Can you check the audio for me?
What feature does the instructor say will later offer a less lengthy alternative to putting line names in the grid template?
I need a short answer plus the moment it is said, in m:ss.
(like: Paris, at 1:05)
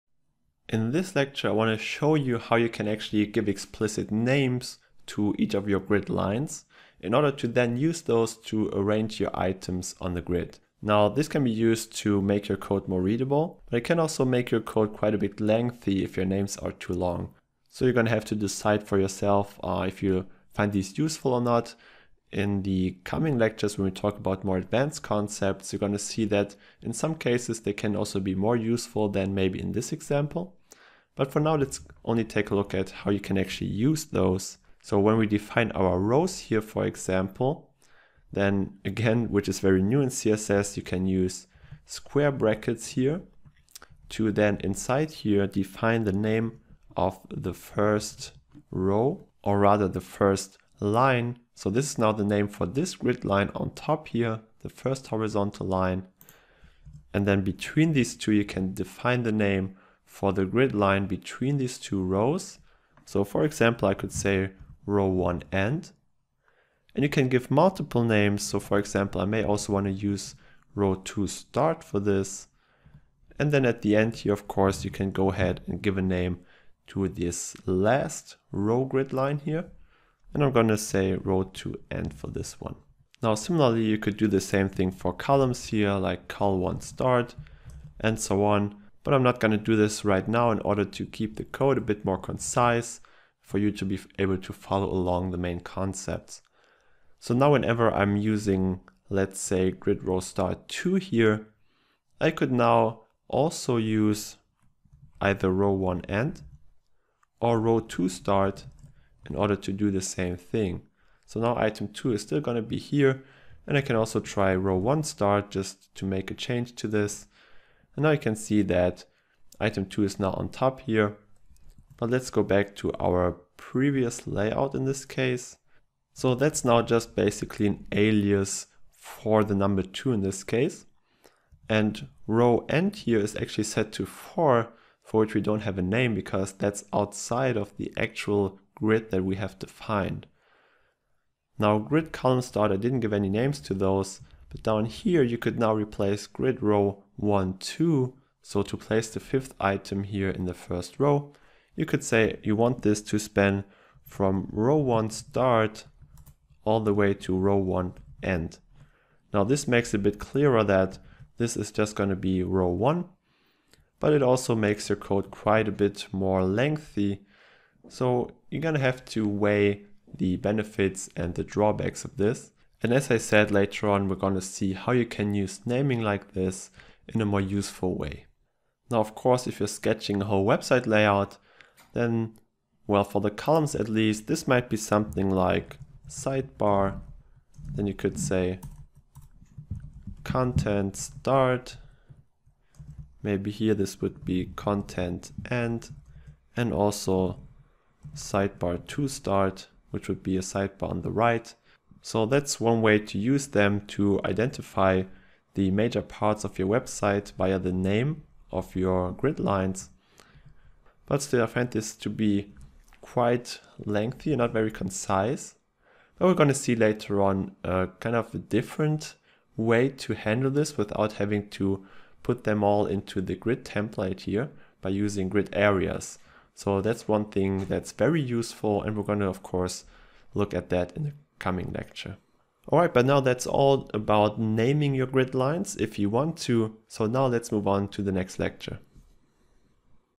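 Grid areas, at 3:45.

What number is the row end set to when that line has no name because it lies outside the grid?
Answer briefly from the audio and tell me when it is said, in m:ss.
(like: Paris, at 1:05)
4, at 2:14.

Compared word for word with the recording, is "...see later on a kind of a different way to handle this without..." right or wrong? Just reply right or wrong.
right.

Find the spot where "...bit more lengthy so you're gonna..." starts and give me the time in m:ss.
2:45.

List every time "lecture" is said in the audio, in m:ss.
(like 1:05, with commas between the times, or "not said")
0:01, 0:23, 3:51, 3:58.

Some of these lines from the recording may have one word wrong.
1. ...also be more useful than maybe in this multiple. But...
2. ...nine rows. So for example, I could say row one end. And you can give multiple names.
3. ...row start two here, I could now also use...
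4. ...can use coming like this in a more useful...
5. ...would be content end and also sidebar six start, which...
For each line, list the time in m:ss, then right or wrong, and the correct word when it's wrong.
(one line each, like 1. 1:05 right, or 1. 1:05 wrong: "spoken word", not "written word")
1. 0:27 wrong: "example", not "multiple"
2. 1:01 wrong: "two", not "nine"
3. 1:40 right
4. 2:55 wrong: "naming", not "coming"
5. 3:14 wrong: "two", not "six".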